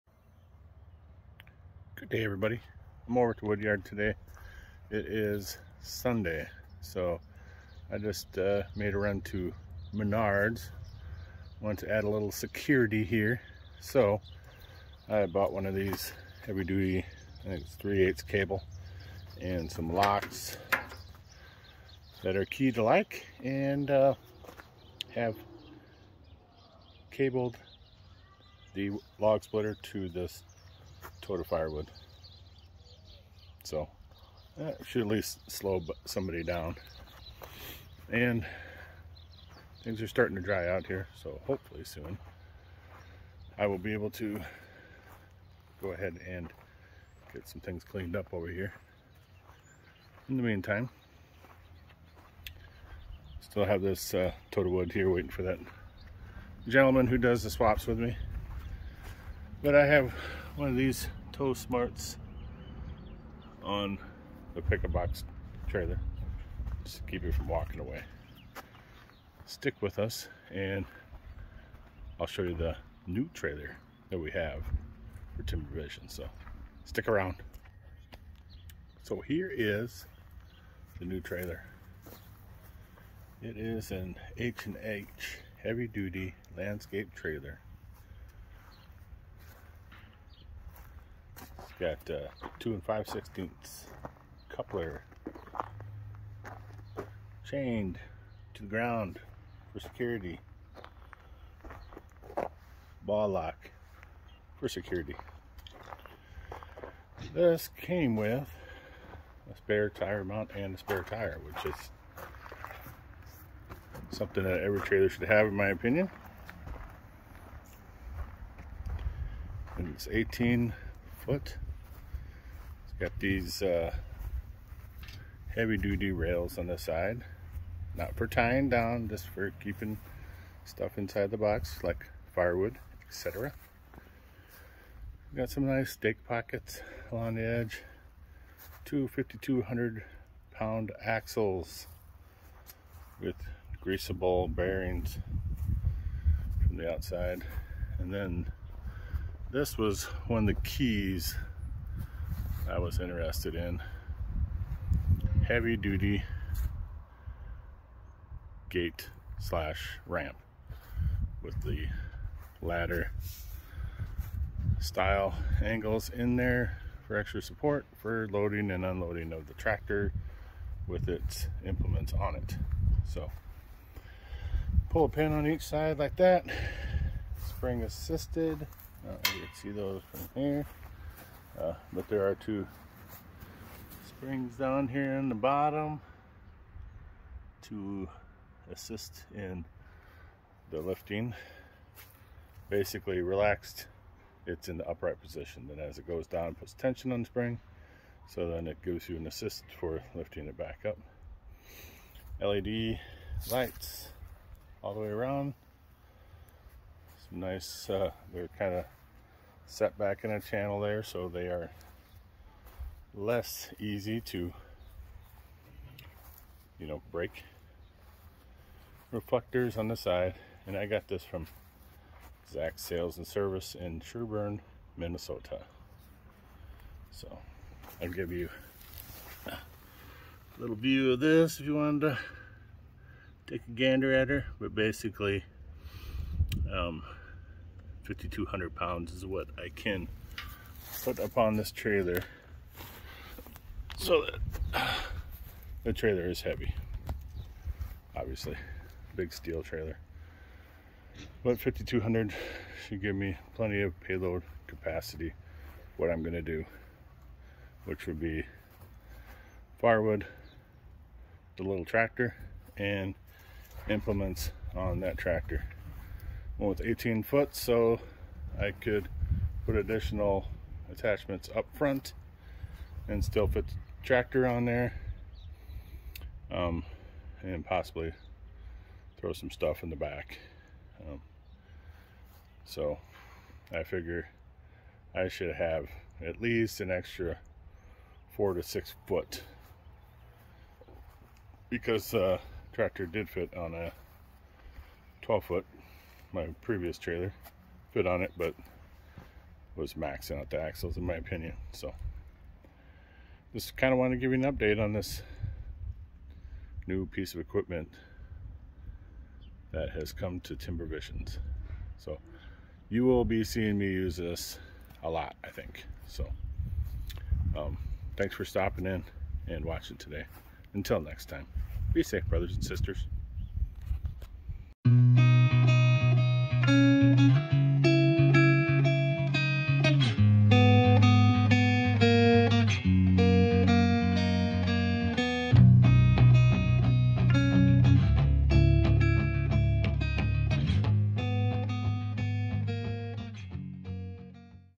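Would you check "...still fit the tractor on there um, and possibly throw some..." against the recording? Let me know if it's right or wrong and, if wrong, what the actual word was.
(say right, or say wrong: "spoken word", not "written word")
right.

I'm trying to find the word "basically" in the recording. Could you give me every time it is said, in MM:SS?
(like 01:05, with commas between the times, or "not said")
03:12, 03:54.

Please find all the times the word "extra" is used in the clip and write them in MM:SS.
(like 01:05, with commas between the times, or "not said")
02:47, 04:46.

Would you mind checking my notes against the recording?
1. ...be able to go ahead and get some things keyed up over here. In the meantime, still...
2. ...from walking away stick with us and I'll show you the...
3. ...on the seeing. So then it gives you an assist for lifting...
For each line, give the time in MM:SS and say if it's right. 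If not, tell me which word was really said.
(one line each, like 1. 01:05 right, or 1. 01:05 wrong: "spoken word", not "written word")
1. 00:43 wrong: "cleaned", not "keyed"
2. 01:07 right
3. 03:17 wrong: "spring", not "seeing".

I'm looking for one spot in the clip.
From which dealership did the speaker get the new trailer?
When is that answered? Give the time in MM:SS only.
03:42.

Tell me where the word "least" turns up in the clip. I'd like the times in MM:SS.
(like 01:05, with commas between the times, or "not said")
00:35, 04:46.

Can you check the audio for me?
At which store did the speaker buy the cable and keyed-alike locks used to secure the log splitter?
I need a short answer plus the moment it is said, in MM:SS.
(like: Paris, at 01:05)
Menards, at 00:09.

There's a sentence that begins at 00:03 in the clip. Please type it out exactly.
I'm over at the woodyard today.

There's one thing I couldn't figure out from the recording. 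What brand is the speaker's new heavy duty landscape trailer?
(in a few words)
H&H.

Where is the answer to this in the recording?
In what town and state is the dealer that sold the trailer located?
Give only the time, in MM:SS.
03:44.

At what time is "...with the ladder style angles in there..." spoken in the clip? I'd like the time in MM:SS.
02:41.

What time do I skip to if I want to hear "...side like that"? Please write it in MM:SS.
02:55.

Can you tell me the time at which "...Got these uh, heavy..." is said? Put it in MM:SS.
02:03.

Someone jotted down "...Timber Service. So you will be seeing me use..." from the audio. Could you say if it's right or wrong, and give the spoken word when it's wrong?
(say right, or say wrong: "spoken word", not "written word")
wrong: "Visions", not "Service".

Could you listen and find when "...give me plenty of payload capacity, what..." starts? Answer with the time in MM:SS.
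04:13.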